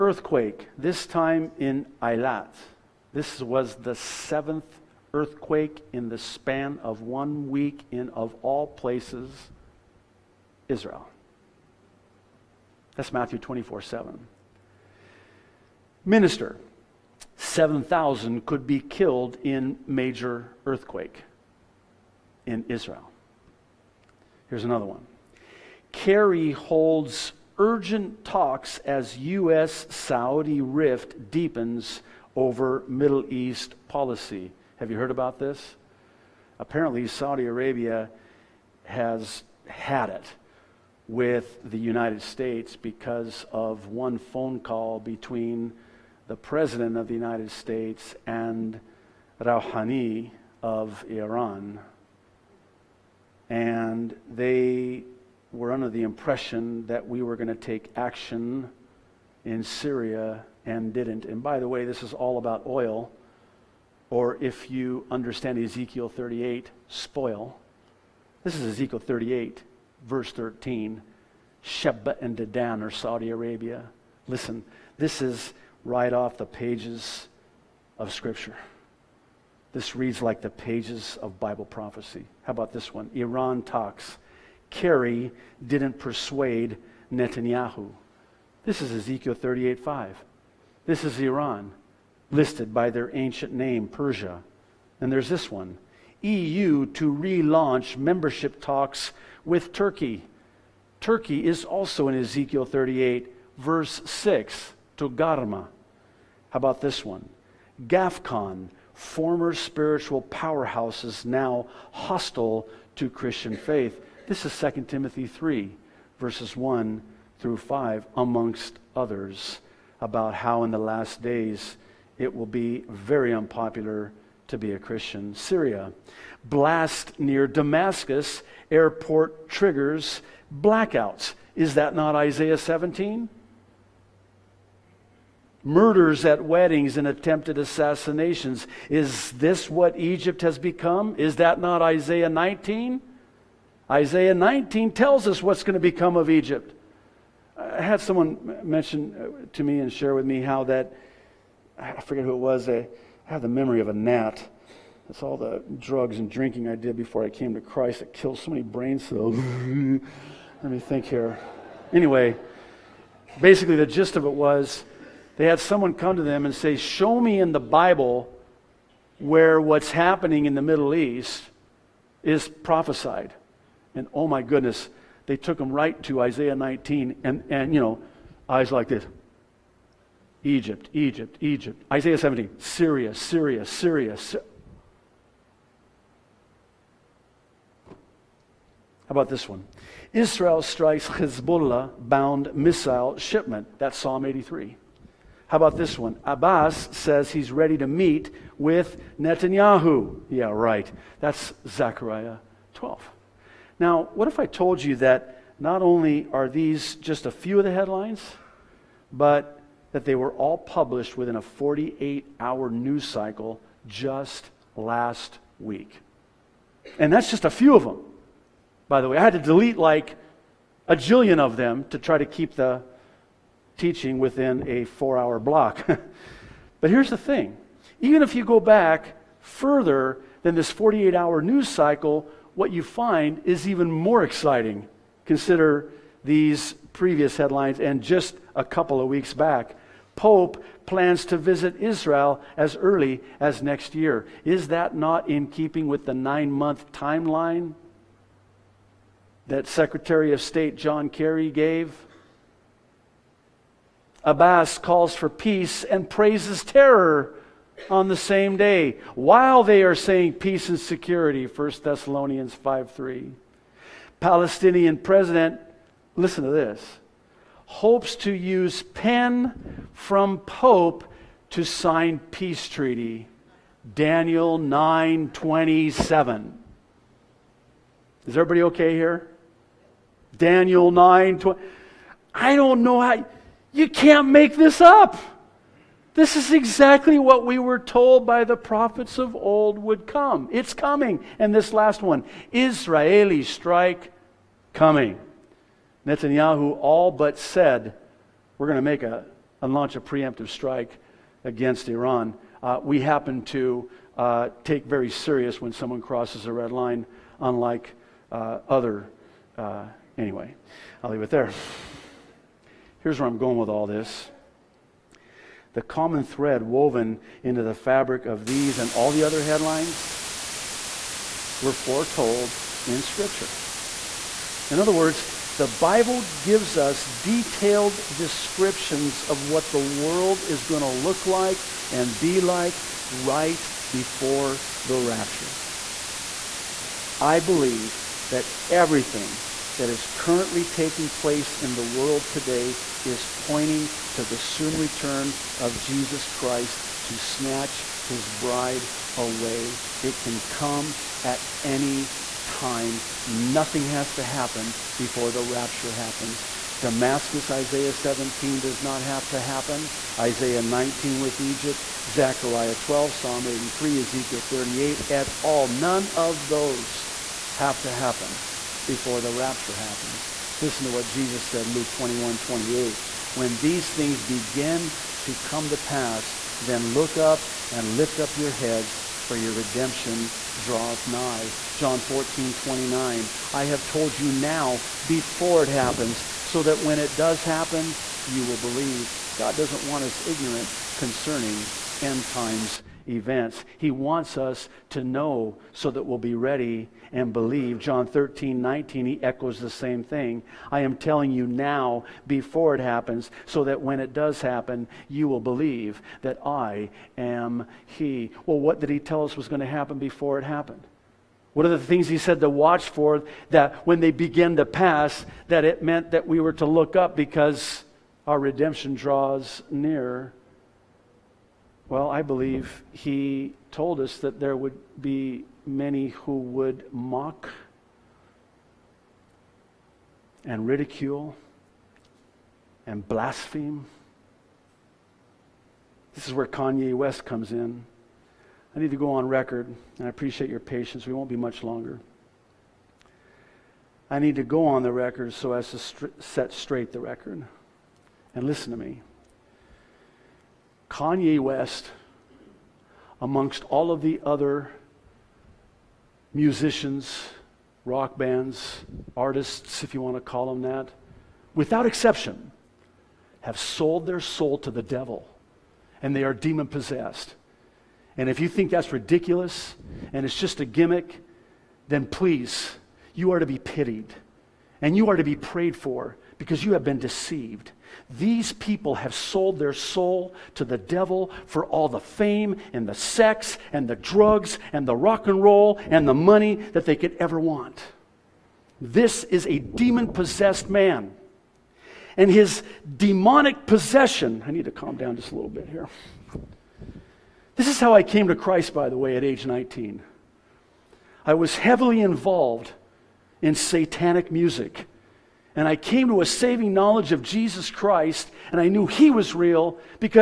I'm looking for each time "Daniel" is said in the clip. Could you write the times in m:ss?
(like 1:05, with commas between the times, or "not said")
4:33, 4:40.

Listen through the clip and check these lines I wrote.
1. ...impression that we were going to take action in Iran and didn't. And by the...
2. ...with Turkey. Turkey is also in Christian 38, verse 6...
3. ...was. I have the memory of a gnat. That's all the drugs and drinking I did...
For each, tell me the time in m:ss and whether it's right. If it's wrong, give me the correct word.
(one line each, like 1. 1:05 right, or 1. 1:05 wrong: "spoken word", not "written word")
1. 0:56 wrong: "Syria", not "Iran"
2. 1:39 wrong: "Ezekiel", not "Christian"
3. 2:32 right.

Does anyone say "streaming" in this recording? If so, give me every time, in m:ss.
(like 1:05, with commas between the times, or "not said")
not said.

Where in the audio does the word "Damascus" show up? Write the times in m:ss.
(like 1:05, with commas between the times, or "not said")
2:07, 5:56.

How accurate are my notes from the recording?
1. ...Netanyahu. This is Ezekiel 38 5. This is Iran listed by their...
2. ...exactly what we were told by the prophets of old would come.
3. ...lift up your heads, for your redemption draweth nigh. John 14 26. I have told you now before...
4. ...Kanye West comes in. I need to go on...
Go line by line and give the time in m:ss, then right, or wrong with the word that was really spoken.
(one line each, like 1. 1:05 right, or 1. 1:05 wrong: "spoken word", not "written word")
1. 1:27 right
2. 4:46 right
3. 6:17 wrong: "29", not "26"
4. 7:16 right.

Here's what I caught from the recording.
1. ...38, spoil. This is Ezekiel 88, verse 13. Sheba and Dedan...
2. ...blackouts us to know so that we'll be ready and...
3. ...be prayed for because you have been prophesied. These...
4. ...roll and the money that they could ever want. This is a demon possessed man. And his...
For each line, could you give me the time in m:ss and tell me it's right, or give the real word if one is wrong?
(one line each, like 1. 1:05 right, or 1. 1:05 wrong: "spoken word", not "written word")
1. 1:06 wrong: "38", not "88"
2. 6:33 wrong: "wants", not "blackouts"
3. 7:55 wrong: "deceived", not "prophesied"
4. 8:05 right.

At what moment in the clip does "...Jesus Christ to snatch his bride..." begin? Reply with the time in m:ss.
5:45.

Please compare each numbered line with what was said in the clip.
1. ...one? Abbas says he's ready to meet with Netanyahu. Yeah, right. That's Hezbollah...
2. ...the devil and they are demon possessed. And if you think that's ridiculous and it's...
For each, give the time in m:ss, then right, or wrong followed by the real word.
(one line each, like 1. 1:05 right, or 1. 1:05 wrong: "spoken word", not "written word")
1. 3:15 wrong: "Zechariah", not "Hezbollah"
2. 7:44 right.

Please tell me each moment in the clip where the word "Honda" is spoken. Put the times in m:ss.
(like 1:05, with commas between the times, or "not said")
not said.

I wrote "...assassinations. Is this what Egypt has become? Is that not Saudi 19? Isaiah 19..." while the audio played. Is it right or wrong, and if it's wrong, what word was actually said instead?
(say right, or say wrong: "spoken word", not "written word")
wrong: "Isaiah", not "Saudi".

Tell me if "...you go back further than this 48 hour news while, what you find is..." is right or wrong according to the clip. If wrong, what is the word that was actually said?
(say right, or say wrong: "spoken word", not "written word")
wrong: "cycle", not "while".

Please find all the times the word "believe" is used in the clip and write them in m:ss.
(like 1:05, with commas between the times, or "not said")
5:37, 6:28, 6:37, 6:45, 7:02.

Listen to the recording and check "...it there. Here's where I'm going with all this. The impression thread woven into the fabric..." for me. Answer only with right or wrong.
wrong.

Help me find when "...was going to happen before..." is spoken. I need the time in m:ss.
6:49.